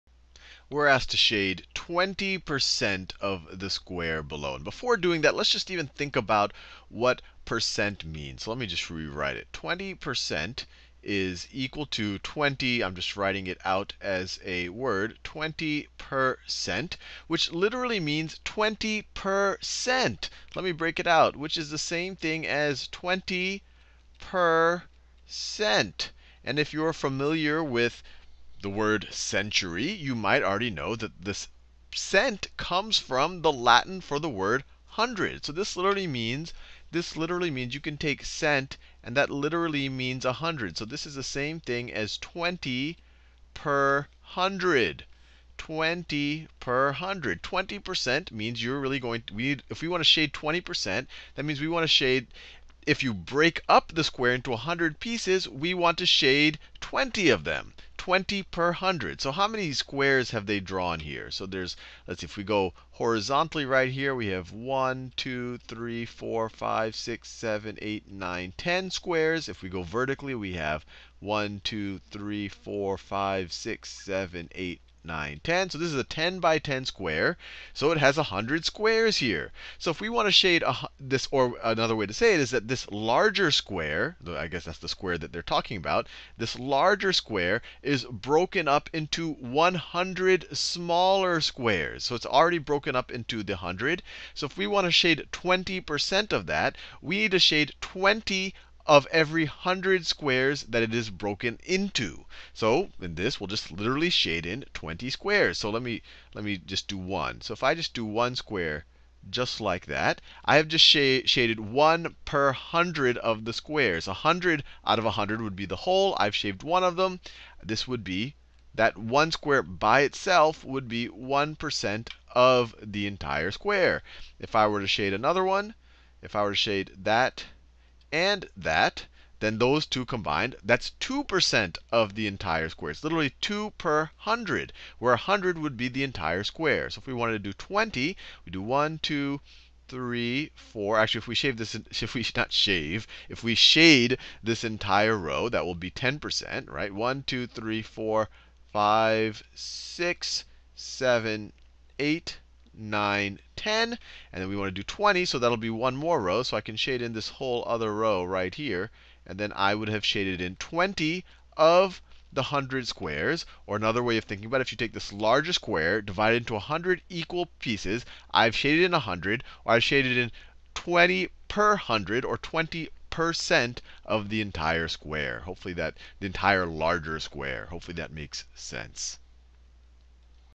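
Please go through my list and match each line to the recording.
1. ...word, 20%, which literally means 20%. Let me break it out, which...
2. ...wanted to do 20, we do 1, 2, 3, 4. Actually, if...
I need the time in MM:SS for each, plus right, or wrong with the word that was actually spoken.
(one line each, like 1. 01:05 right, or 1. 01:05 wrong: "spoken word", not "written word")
1. 00:14 right
2. 02:17 right.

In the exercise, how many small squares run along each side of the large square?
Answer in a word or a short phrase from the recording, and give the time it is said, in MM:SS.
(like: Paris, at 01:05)
10, at 01:16.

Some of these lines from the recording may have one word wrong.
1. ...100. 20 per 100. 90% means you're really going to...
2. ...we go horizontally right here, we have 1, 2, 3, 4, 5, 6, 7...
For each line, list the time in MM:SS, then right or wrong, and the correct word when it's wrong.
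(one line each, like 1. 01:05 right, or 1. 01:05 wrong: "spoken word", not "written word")
1. 00:44 wrong: "20", not "90"
2. 01:02 right.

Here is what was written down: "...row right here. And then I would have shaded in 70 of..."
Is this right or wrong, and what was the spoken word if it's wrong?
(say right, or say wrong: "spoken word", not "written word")
wrong: "20", not "70".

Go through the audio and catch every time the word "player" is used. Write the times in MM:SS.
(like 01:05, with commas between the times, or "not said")
not said.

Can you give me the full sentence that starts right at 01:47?
So if I just do 1 square just like that, I have just sh shaded 1 per 100 of the squares.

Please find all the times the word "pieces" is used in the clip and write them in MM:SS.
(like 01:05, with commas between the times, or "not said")
00:54, 02:47.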